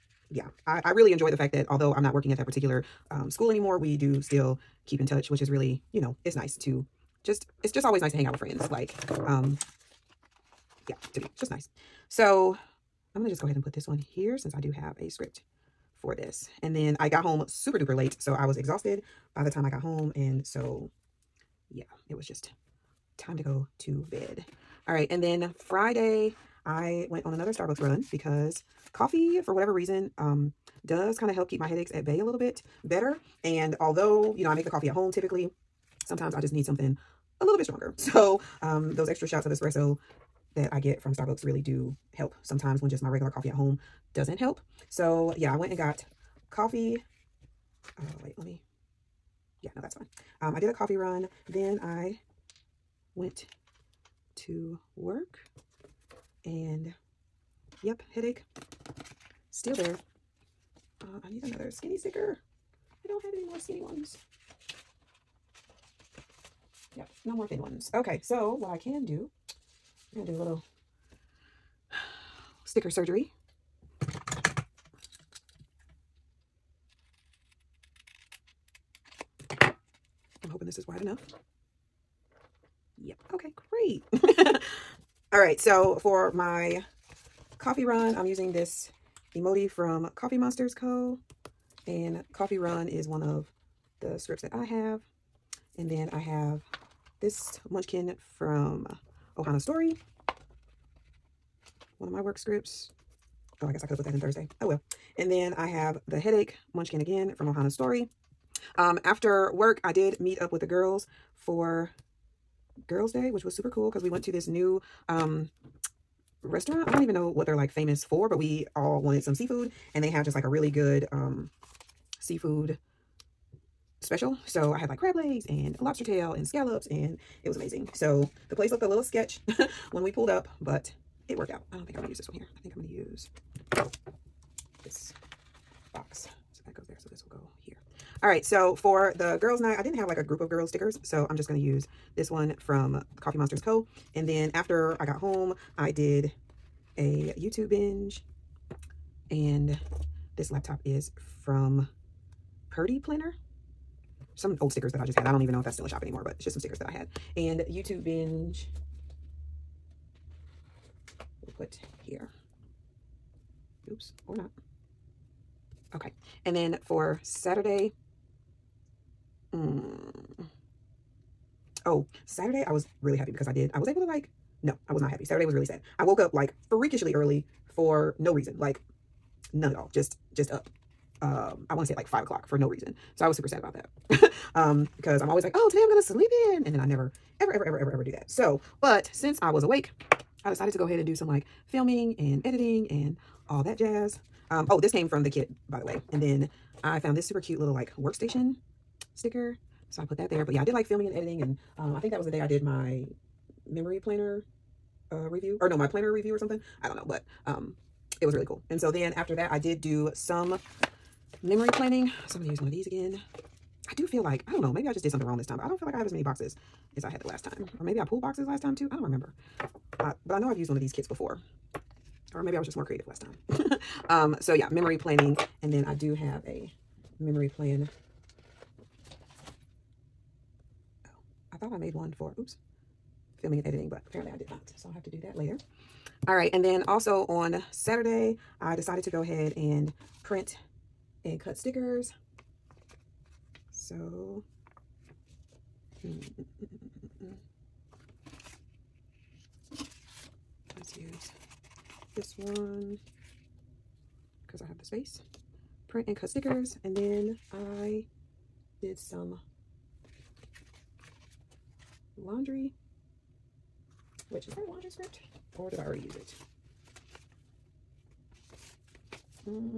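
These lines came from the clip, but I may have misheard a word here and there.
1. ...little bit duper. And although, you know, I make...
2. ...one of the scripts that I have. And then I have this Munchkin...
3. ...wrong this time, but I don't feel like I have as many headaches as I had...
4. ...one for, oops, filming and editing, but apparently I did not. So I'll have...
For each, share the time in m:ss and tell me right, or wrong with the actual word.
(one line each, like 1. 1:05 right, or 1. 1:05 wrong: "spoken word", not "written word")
1. 0:32 wrong: "better", not "duper"
2. 1:33 right
3. 3:35 wrong: "boxes", not "headaches"
4. 3:51 right.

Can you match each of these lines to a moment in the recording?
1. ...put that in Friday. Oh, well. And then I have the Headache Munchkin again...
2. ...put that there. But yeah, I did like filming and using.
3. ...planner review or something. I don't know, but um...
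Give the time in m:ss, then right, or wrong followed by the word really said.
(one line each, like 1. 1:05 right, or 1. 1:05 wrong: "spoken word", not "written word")
1. 1:43 wrong: "Thursday", not "Friday"
2. 3:20 wrong: "editing", not "using"
3. 3:25 right.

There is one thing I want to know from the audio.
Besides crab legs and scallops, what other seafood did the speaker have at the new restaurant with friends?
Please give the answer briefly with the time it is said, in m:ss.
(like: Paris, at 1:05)
lobster tail, at 2:05.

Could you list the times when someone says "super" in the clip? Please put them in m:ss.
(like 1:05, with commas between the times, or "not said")
0:17, 1:53, 3:03, 3:17.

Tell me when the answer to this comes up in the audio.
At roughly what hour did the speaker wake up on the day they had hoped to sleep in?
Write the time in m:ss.
3:02.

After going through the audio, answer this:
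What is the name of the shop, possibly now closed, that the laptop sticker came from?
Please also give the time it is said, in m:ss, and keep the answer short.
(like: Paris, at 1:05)
Purdee Planner, at 2:32.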